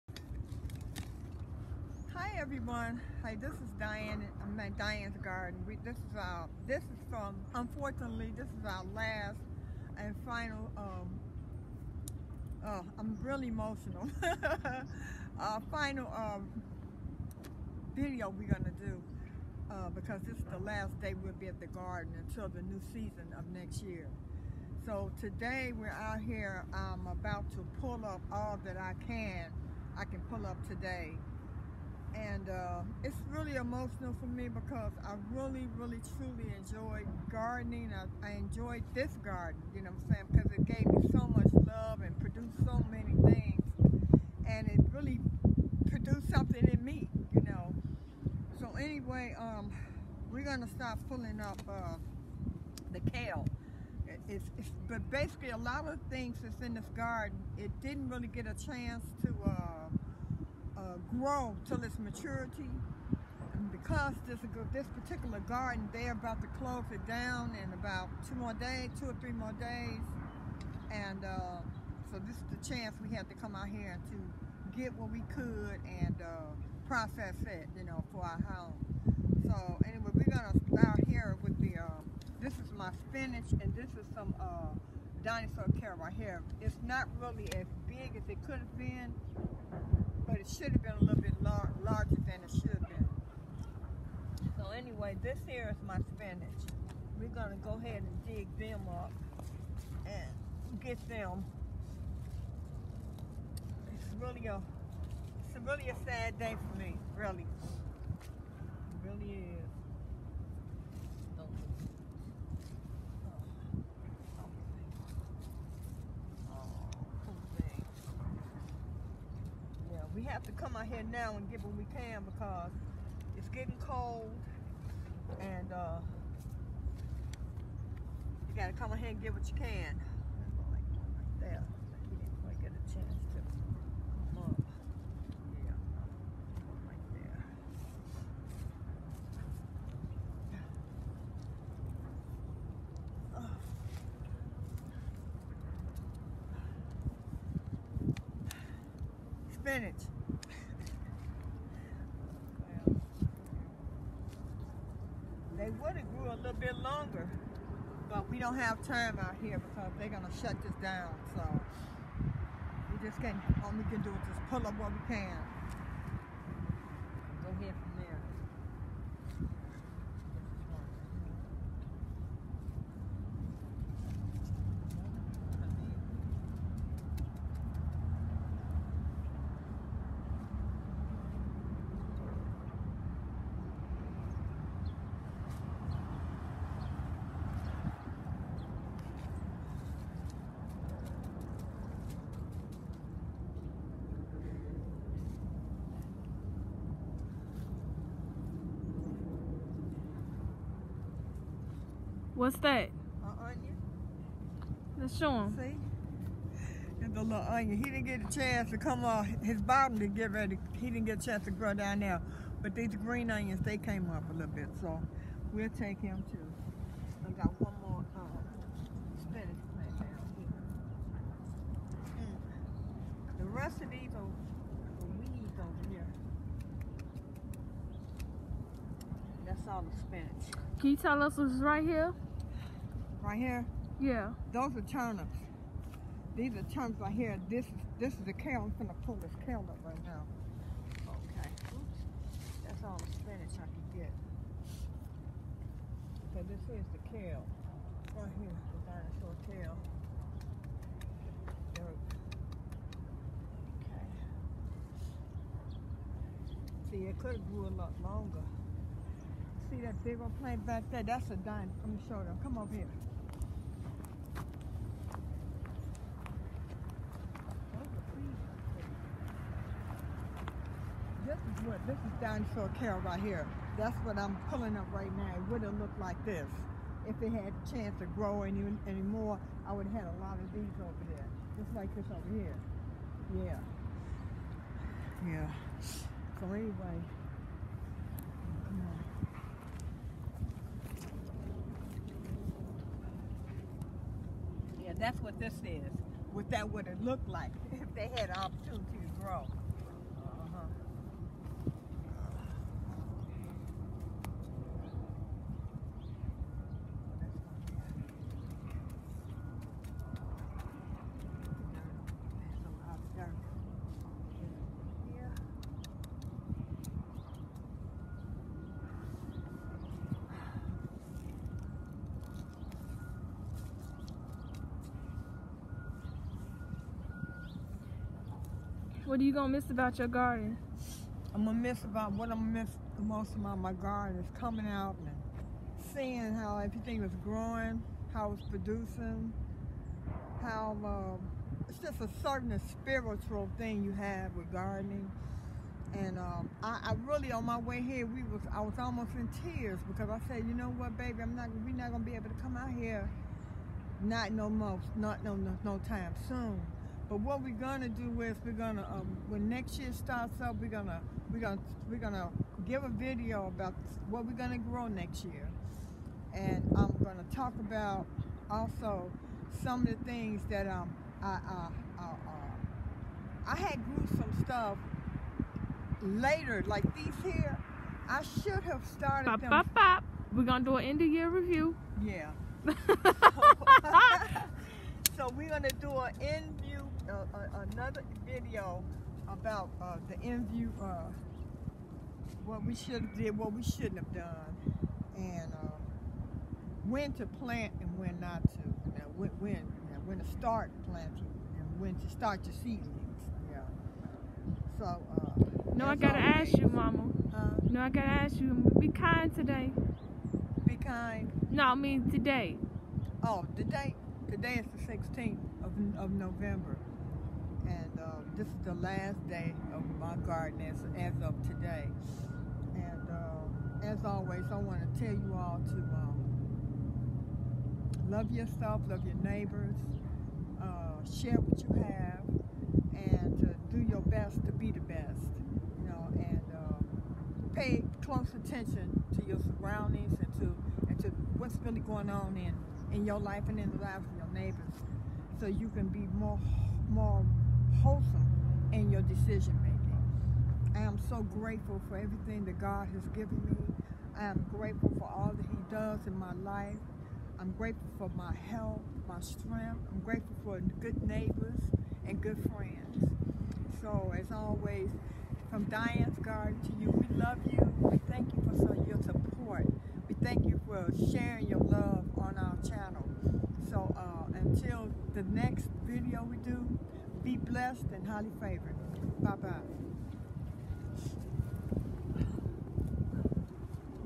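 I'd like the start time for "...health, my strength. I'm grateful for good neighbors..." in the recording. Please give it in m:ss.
7:38.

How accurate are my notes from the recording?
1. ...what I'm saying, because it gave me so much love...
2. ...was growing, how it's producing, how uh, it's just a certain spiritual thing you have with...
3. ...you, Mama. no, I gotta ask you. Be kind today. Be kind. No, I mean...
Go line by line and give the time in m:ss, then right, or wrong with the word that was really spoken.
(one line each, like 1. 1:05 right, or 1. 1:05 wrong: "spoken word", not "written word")
1. 0:40 right
2. 5:37 right
3. 6:46 right.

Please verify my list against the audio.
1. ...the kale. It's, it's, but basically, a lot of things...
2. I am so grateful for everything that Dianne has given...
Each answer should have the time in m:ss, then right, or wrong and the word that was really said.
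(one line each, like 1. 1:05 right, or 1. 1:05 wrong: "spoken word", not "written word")
1. 0:52 right
2. 7:30 wrong: "God", not "Dianne".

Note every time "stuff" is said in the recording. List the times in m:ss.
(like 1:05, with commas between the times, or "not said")
6:14.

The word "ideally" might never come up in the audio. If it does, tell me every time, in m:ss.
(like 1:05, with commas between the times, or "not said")
not said.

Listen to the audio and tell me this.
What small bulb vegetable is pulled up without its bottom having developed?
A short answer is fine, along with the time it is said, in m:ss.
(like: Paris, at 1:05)
An onion, at 3:23.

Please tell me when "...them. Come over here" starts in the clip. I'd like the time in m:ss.
4:22.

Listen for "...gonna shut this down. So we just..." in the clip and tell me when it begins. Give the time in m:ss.
2:40.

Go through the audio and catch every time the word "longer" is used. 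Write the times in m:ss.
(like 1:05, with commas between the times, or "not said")
2:36, 4:18.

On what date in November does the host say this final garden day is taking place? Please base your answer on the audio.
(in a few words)
16th.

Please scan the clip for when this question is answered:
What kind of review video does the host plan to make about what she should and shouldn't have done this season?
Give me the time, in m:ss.
6:20.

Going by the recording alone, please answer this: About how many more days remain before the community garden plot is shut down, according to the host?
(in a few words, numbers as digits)
2 or 3.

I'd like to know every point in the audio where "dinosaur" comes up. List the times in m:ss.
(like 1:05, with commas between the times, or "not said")
1:25, 4:08, 4:21, 4:32.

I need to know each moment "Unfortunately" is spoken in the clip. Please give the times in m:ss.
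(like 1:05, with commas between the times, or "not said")
0:07.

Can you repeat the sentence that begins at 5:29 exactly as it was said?
What are you gonna miss about your garden?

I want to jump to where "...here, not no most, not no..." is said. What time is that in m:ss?
5:52.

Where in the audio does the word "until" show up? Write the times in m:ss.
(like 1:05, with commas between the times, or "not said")
0:22, 7:54.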